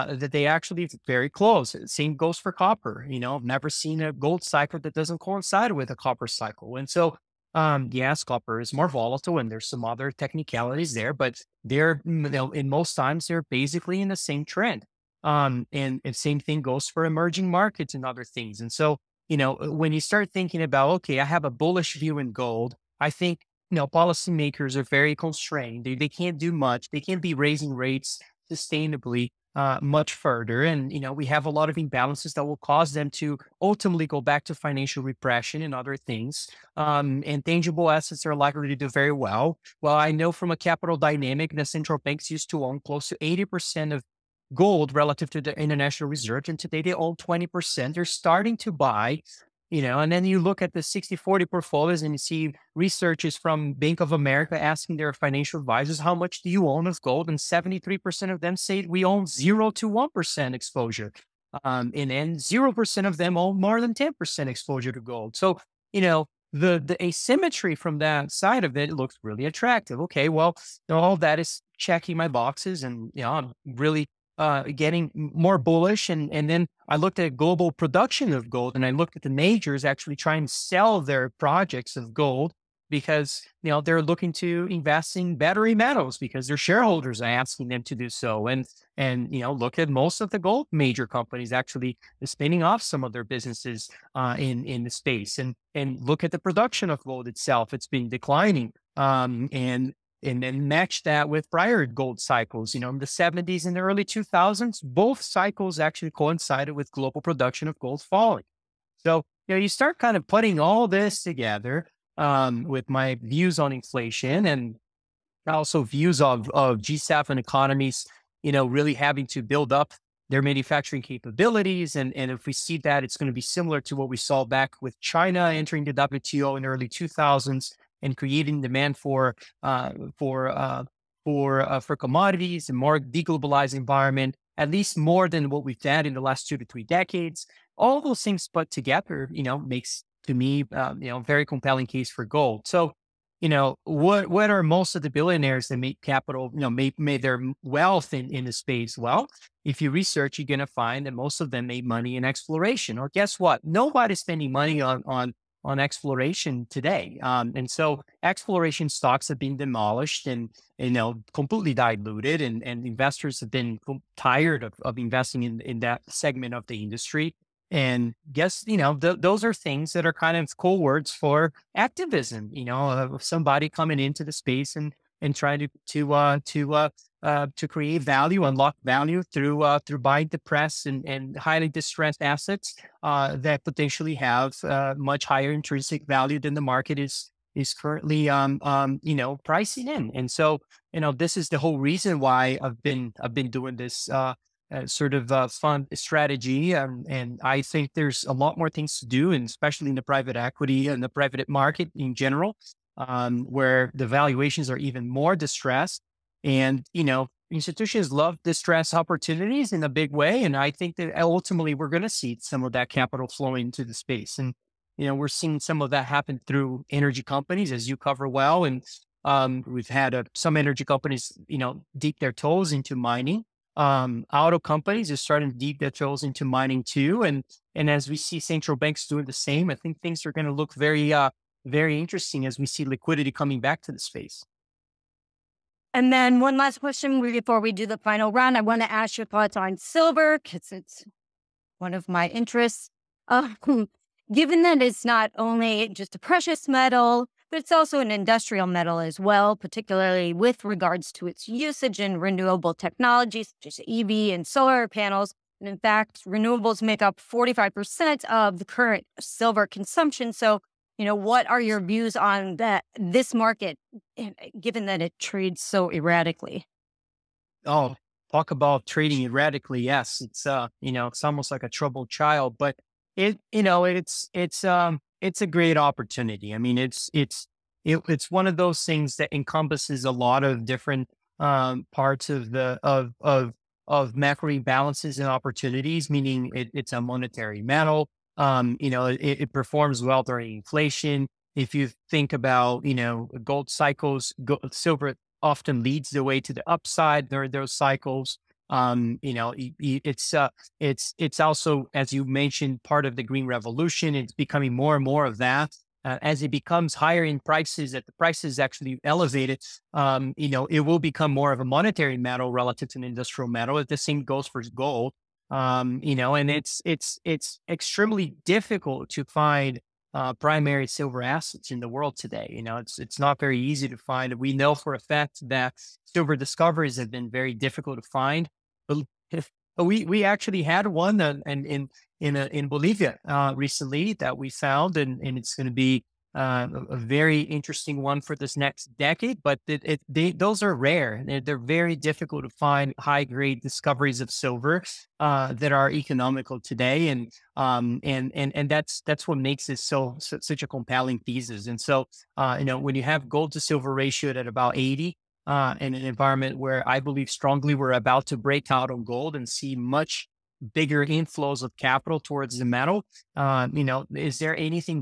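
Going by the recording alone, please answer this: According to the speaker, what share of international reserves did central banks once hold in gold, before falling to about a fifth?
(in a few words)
80%.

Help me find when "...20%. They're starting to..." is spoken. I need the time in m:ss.
0:47.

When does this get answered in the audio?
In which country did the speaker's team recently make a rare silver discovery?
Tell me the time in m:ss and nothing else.
5:32.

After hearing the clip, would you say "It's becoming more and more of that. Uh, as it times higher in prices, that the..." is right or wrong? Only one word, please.
wrong.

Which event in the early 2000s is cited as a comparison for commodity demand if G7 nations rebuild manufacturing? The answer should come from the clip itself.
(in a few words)
China entering the WTO.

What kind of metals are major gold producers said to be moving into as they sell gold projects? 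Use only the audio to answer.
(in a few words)
Battery metals.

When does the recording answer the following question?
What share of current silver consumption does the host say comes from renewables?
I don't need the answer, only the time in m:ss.
4:17.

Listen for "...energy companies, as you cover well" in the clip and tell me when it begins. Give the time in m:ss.
3:36.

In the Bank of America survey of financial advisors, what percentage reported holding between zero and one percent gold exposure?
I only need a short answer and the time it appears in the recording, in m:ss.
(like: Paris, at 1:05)
73%, at 0:57.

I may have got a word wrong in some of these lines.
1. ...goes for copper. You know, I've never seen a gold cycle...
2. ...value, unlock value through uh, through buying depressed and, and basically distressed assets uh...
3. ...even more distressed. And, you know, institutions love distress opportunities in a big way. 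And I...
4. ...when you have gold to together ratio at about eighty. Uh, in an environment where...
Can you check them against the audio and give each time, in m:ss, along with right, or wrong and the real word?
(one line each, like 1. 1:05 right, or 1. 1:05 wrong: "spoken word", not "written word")
1. 0:02 right
2. 2:58 wrong: "highly", not "basically"
3. 3:24 right
4. 5:52 wrong: "silver", not "together".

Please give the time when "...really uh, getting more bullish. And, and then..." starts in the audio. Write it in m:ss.
1:13.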